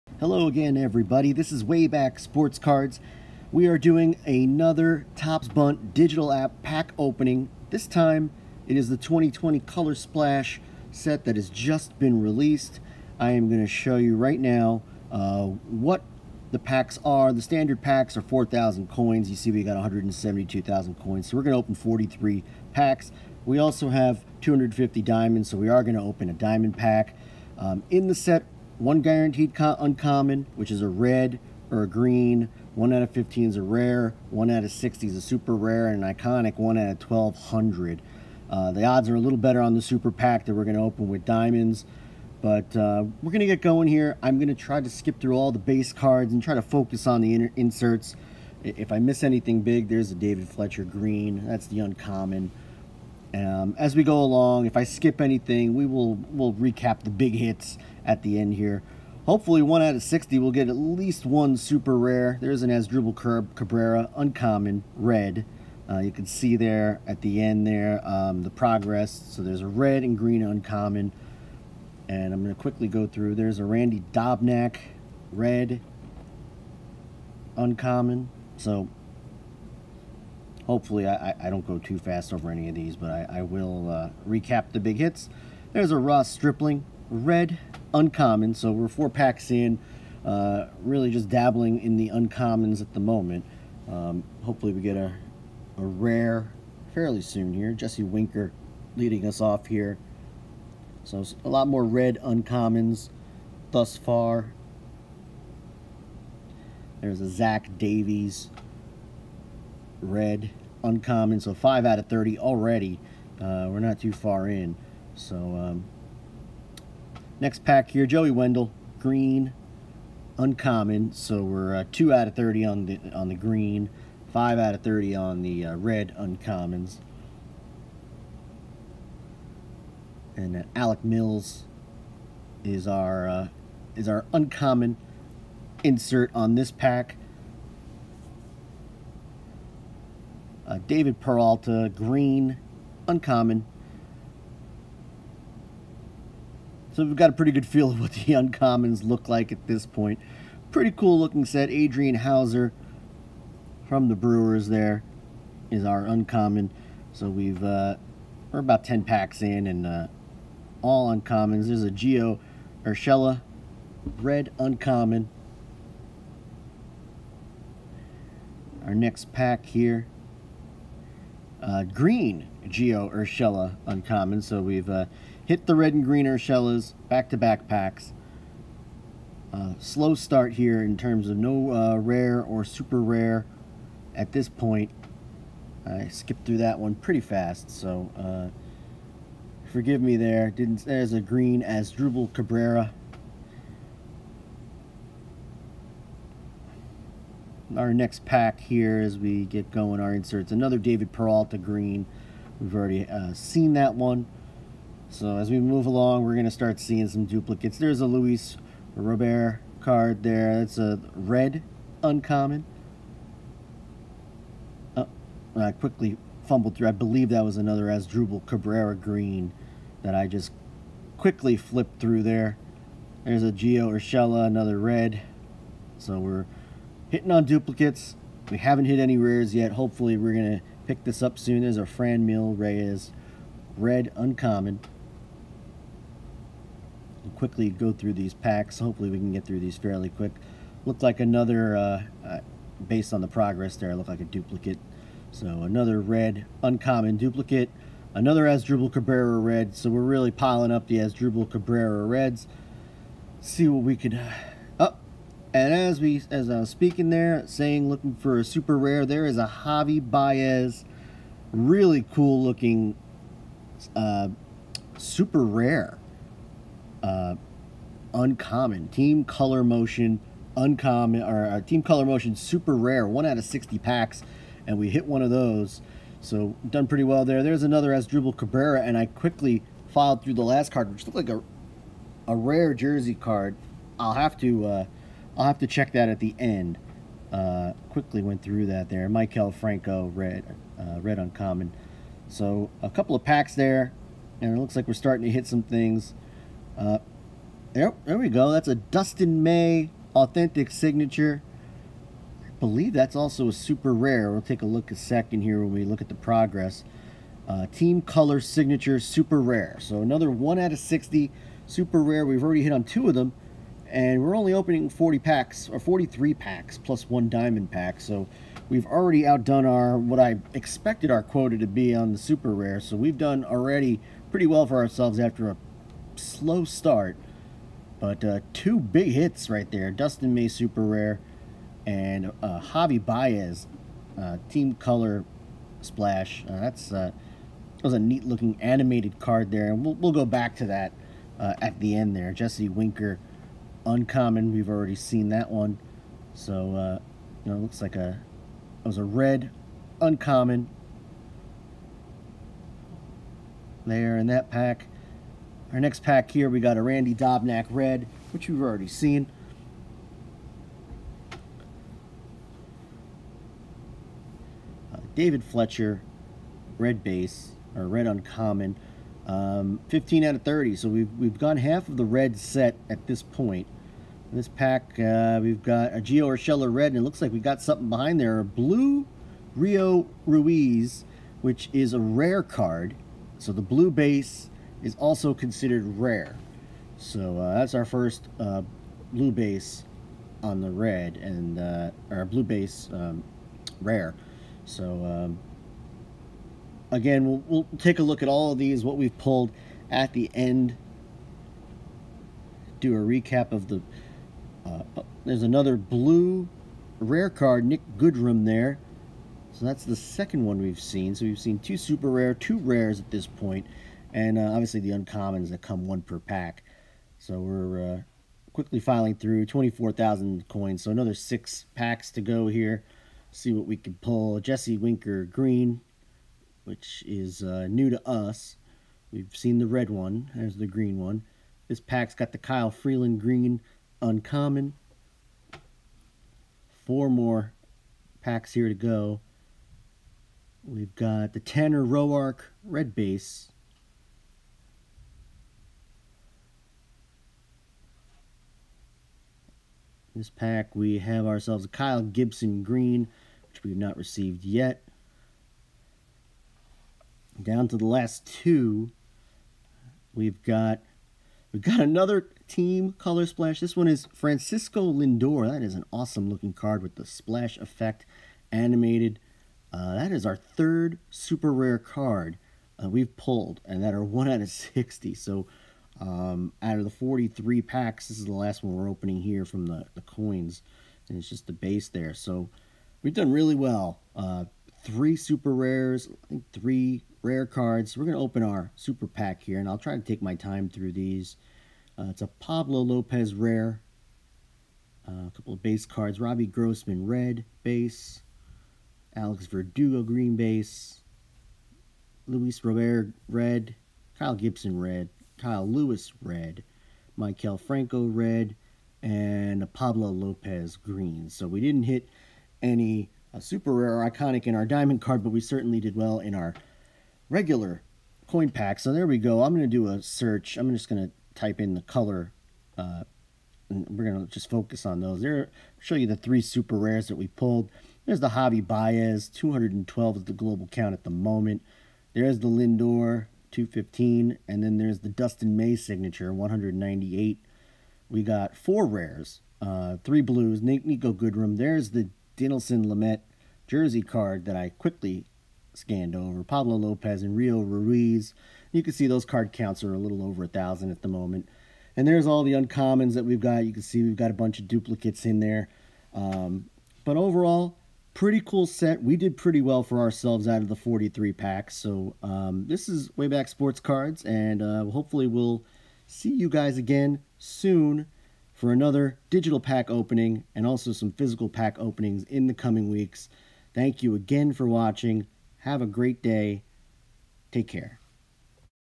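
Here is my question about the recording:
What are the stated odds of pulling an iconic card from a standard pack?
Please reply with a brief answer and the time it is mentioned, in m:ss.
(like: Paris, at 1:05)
1 out of 1,200, at 0:36.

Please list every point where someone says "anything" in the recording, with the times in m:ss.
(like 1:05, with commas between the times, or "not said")
0:49, 0:55.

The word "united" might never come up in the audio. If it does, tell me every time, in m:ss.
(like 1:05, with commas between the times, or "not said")
not said.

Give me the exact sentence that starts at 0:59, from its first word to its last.
Hopefully, one out of 60 will get at least one super rare.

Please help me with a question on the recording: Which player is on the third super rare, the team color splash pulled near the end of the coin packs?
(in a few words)
Francisco Lindor.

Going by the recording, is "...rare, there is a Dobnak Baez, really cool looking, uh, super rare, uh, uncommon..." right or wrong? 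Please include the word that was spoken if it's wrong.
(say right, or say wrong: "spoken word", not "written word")
wrong: "Javi", not "Dobnak".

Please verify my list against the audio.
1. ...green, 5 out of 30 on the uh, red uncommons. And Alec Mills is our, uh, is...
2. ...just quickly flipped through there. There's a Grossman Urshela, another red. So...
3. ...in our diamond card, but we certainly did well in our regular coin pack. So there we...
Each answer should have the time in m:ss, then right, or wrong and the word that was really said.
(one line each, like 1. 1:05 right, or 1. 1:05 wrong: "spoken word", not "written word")
1. 2:03 right
2. 3:40 wrong: "Gio", not "Grossman"
3. 8:34 right.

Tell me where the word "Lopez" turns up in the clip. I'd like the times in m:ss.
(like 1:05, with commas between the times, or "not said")
8:12, 8:30, 9:06.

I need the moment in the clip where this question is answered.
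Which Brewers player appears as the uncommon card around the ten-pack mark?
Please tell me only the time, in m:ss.
2:31.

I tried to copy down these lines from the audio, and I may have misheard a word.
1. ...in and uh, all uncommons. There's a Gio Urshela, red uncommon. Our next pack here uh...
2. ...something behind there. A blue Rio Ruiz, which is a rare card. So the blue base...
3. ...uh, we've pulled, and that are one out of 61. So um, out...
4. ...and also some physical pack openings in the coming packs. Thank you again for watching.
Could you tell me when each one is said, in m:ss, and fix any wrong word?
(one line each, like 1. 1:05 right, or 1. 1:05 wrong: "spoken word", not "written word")
1. 2:39 right
2. 6:17 right
3. 7:52 wrong: "60", not "61"
4. 9:30 wrong: "weeks", not "packs".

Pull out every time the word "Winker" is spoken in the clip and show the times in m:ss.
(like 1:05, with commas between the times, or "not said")
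1:38, 5:42, 7:04.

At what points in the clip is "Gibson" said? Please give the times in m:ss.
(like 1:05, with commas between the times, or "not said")
7:32, 8:24.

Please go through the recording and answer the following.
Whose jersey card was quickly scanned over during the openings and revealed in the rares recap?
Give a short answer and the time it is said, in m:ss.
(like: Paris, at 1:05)
Dinelson Lamet, at 9:02.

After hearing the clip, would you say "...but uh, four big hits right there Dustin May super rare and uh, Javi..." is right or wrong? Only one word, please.
wrong.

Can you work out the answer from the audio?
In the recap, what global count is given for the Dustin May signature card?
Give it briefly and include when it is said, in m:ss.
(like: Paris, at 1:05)
198, at 8:56.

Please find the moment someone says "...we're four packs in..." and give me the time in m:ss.
1:28.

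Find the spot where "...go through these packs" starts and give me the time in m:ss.
3:57.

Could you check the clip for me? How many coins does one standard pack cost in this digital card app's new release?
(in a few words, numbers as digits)
4,000.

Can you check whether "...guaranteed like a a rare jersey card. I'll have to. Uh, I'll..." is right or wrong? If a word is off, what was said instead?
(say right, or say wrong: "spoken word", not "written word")
wrong: "looked", not "guaranteed".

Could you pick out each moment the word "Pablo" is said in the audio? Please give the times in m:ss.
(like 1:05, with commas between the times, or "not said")
8:12, 8:29, 9:06.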